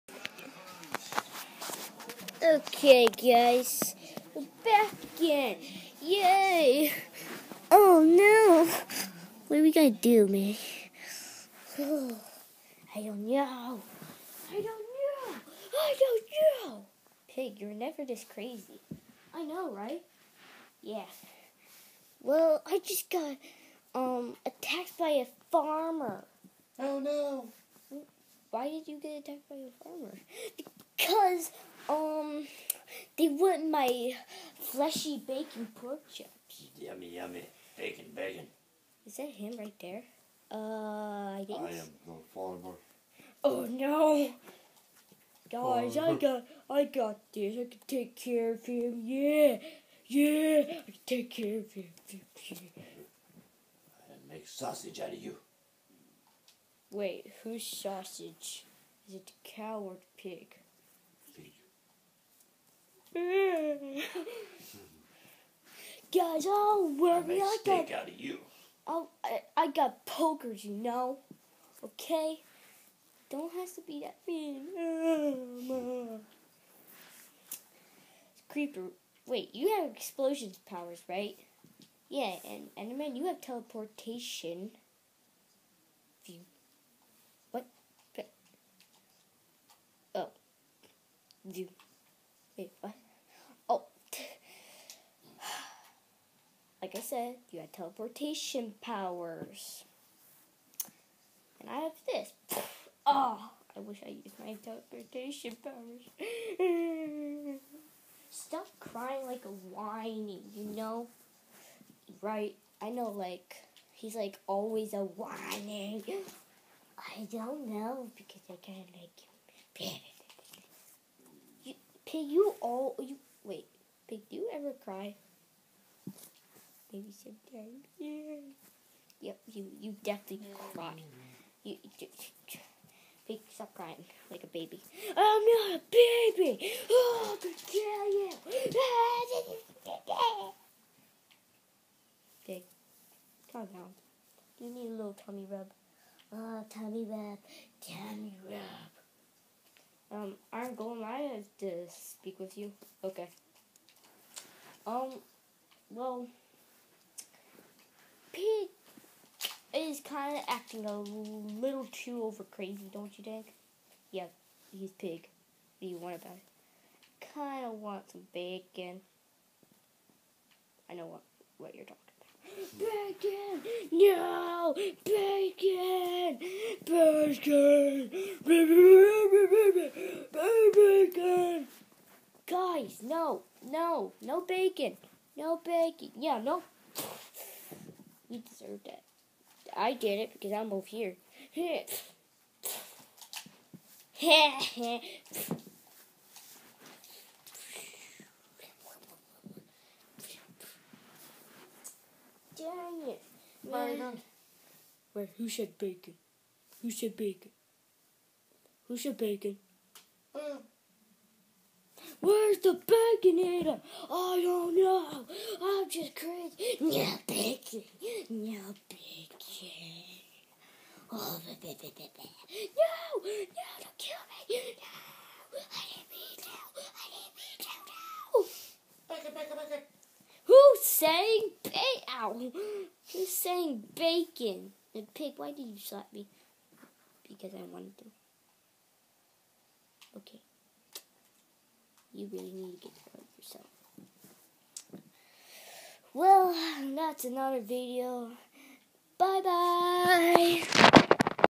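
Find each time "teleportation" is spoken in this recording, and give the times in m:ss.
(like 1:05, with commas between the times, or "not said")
1:23, 1:37, 1:44.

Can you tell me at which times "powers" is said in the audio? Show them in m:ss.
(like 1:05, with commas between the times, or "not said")
1:20, 1:38, 1:45.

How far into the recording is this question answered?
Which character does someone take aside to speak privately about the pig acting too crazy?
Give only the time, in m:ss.
2:30.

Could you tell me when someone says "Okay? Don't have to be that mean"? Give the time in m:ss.
1:11.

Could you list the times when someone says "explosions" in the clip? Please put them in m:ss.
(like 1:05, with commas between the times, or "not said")
1:19.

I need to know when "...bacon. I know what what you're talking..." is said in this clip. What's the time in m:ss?
2:48.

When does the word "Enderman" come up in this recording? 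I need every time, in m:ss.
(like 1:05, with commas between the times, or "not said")
1:22.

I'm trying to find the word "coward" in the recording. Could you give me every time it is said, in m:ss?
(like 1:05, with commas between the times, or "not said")
0:59.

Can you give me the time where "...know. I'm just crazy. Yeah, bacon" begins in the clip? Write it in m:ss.
3:34.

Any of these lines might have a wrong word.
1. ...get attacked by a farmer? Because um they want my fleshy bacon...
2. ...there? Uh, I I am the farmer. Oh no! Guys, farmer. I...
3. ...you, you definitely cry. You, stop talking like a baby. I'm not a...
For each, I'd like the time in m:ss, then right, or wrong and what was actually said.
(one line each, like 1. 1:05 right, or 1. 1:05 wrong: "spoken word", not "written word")
1. 0:28 right
2. 0:39 right
3. 2:09 wrong: "crying", not "talking".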